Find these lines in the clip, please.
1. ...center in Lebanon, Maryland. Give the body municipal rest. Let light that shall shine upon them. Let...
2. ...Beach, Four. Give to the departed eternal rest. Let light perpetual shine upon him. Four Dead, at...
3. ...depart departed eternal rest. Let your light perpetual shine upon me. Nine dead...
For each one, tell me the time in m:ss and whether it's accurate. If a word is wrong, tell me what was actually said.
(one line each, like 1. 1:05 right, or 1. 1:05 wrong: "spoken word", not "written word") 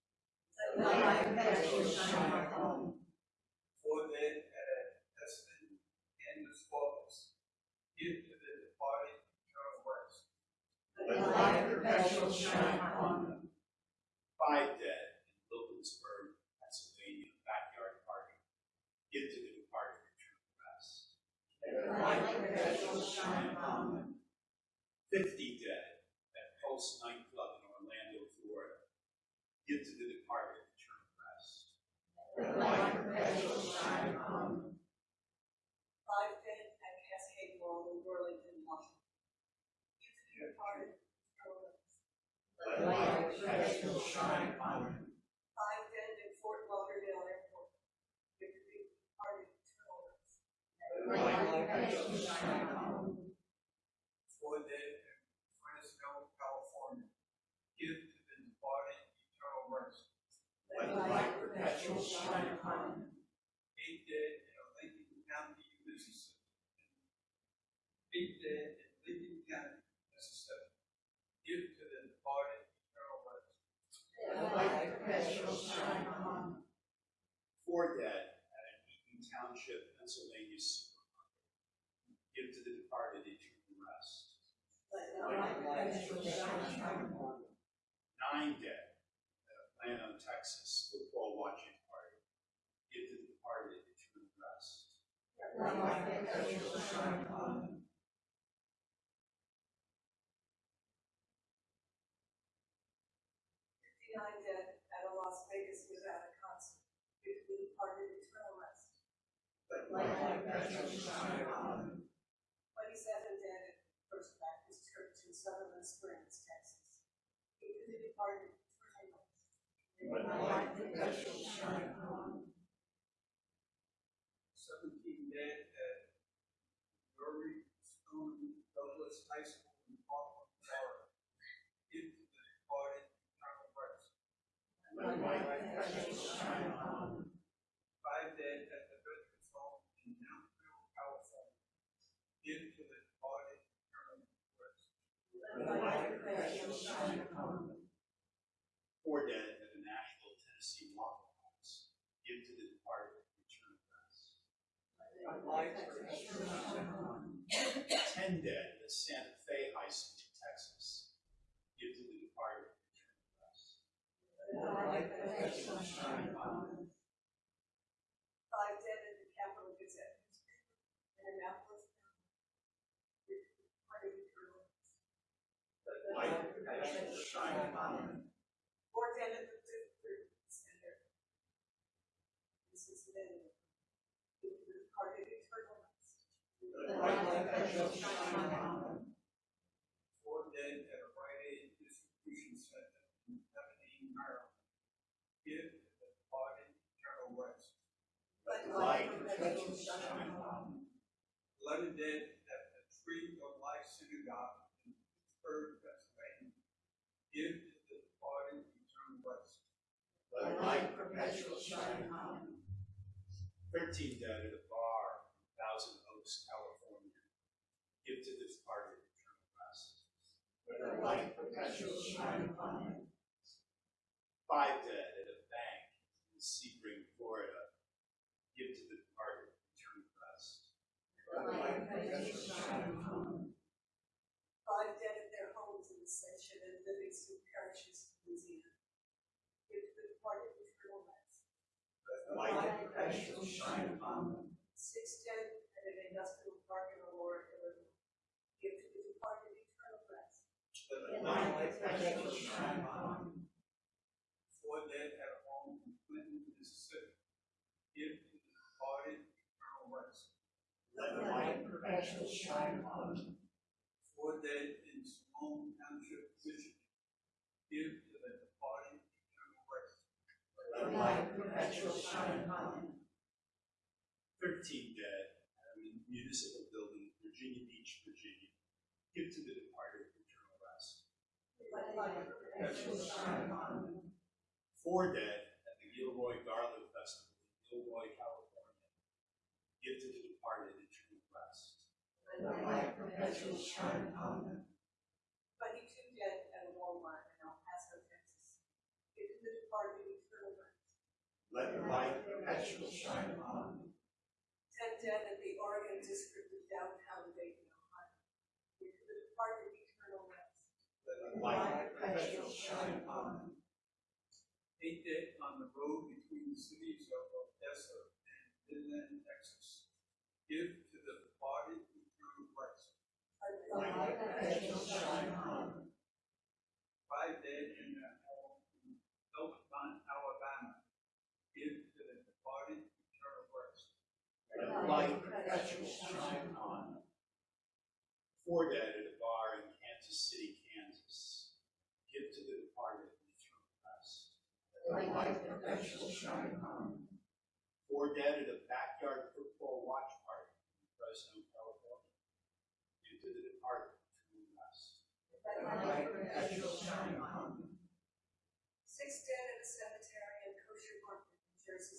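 1. 3:12 wrong: "eternal", not "municipal"
2. 4:37 wrong: "Virginia", not "Four"
3. 5:09 wrong: "Eight", not "Nine".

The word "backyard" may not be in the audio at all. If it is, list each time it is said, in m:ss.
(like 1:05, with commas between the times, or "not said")
0:17, 5:48.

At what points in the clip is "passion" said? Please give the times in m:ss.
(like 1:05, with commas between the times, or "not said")
4:02, 4:11, 4:21.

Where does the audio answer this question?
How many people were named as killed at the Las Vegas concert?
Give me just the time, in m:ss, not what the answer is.
1:43.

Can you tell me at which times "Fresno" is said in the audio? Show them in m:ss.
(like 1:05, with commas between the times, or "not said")
0:55, 5:50.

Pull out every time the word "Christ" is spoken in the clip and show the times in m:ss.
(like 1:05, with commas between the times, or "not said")
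4:02, 4:11, 4:21.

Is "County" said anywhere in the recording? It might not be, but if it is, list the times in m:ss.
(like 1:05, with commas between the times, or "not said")
1:05.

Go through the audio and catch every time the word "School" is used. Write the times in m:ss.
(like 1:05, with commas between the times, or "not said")
2:09, 2:39.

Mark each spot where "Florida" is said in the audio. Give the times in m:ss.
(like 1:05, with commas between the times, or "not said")
0:28, 2:10, 3:47.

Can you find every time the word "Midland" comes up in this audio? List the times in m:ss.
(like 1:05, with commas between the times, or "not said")
5:18.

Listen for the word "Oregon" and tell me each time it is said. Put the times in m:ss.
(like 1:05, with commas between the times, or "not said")
5:05.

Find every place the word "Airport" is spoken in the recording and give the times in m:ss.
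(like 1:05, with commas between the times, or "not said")
0:47.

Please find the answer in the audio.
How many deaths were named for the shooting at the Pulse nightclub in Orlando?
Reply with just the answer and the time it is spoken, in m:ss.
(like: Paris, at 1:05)
50, at 0:25.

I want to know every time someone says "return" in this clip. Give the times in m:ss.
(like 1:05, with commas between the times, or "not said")
2:36, 2:44.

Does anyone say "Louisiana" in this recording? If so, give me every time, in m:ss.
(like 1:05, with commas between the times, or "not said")
3:58.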